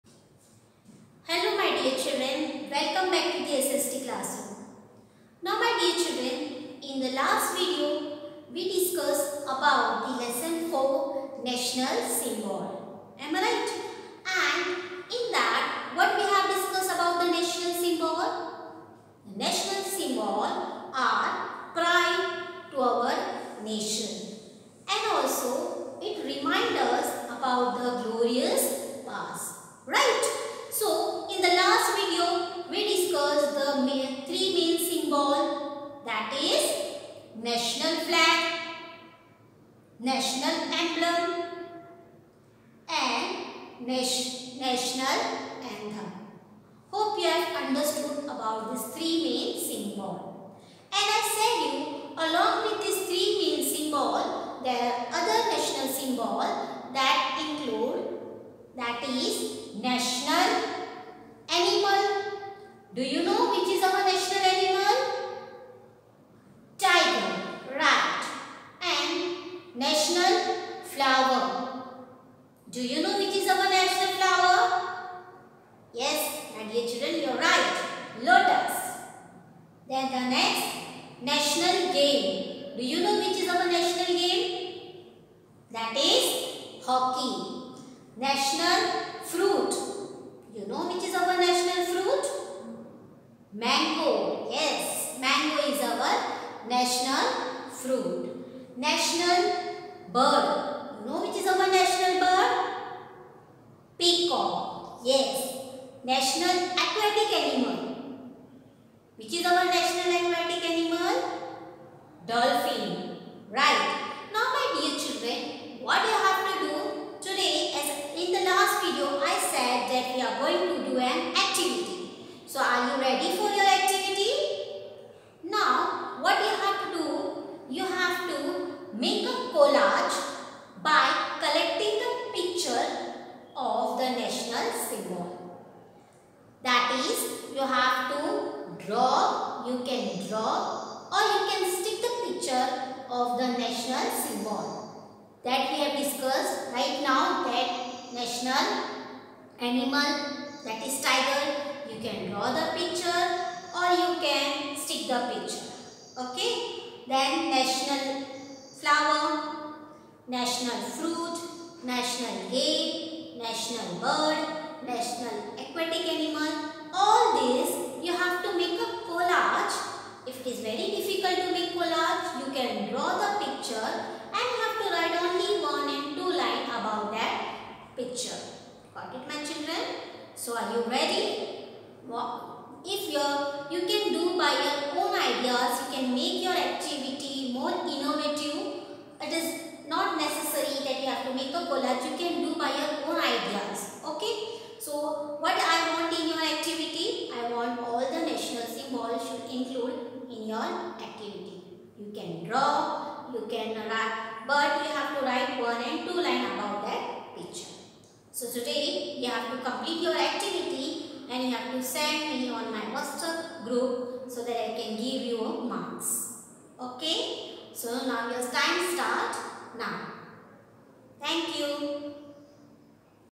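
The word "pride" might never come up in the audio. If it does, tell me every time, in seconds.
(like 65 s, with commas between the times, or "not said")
21 s.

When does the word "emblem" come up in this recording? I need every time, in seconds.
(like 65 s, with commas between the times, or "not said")
40 s.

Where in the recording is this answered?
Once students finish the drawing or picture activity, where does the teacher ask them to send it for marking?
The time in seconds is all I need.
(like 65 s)
212 s.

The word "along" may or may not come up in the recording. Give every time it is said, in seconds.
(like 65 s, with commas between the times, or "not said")
52 s.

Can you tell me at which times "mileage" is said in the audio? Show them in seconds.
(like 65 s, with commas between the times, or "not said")
not said.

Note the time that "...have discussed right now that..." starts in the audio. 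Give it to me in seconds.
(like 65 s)
145 s.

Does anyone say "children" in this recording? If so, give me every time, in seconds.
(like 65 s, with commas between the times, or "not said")
6 s, 76 s, 114 s, 179 s.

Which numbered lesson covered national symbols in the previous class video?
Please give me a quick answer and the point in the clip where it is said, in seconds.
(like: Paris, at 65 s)
Lesson 4, at 10 s.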